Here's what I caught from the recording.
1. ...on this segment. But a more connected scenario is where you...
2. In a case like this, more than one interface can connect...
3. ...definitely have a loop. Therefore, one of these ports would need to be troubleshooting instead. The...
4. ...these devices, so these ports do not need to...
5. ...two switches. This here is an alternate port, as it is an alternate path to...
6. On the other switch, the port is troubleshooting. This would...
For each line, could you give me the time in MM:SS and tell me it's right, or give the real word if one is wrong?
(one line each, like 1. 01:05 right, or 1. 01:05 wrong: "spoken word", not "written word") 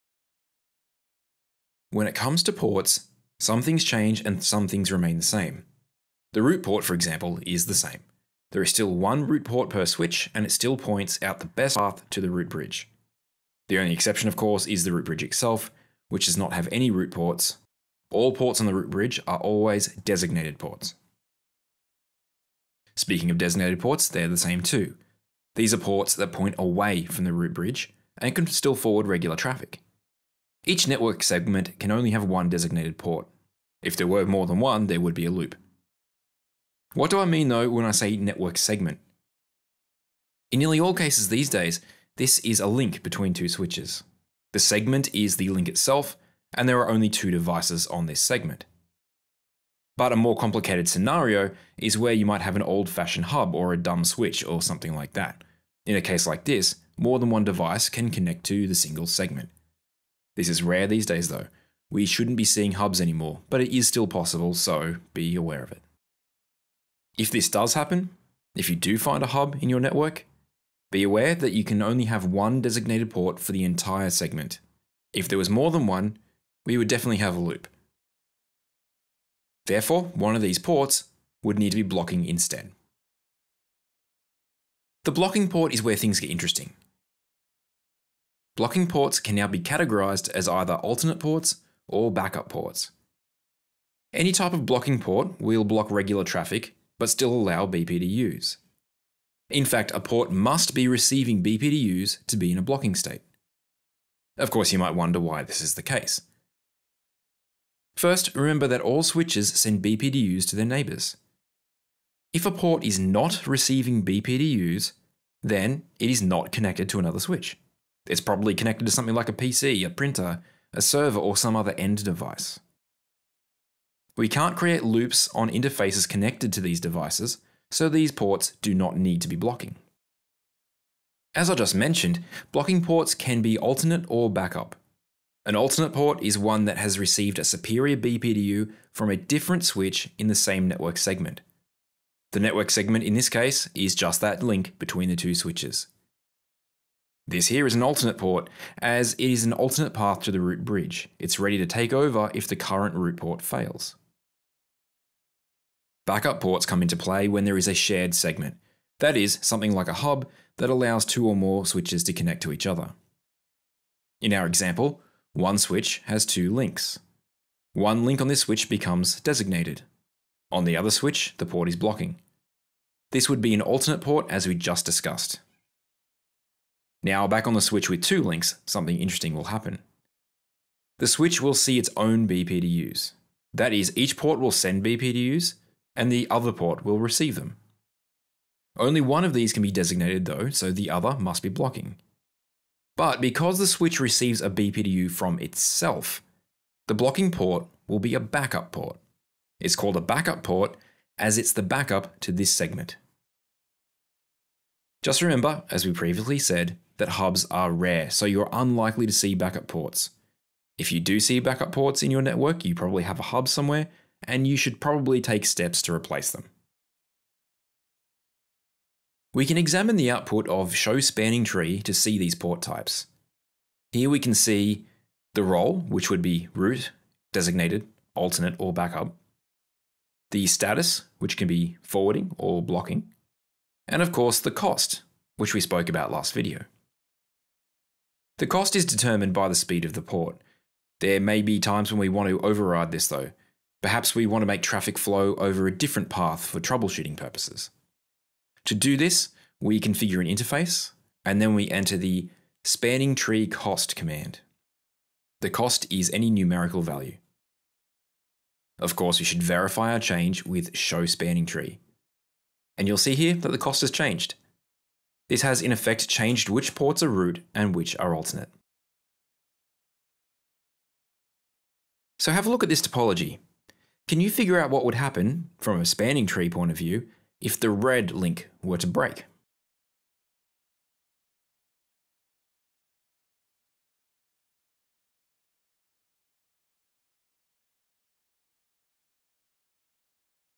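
1. 00:47 wrong: "complicated", not "connected"
2. 00:55 wrong: "device", not "interface"
3. 01:16 wrong: "blocking", not "troubleshooting"
4. 02:06 right
5. 02:25 right
6. 02:50 wrong: "blocking", not "troubleshooting".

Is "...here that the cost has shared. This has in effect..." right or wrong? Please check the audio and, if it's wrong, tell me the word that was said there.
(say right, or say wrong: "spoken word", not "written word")
wrong: "changed", not "shared".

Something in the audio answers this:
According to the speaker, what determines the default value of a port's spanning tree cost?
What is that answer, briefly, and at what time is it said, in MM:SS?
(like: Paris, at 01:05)
Speed of the port, at 03:59.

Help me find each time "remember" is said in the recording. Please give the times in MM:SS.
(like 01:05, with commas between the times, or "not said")
01:48, 03:25.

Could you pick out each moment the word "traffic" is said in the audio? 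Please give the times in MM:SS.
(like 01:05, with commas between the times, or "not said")
00:29, 01:36, 04:04.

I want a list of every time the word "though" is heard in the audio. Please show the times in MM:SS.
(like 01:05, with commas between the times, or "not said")
00:37, 01:01, 03:10, 04:03.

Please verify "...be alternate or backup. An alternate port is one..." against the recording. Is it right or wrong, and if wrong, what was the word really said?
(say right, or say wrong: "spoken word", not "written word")
right.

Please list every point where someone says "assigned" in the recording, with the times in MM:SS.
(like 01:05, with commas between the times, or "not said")
not said.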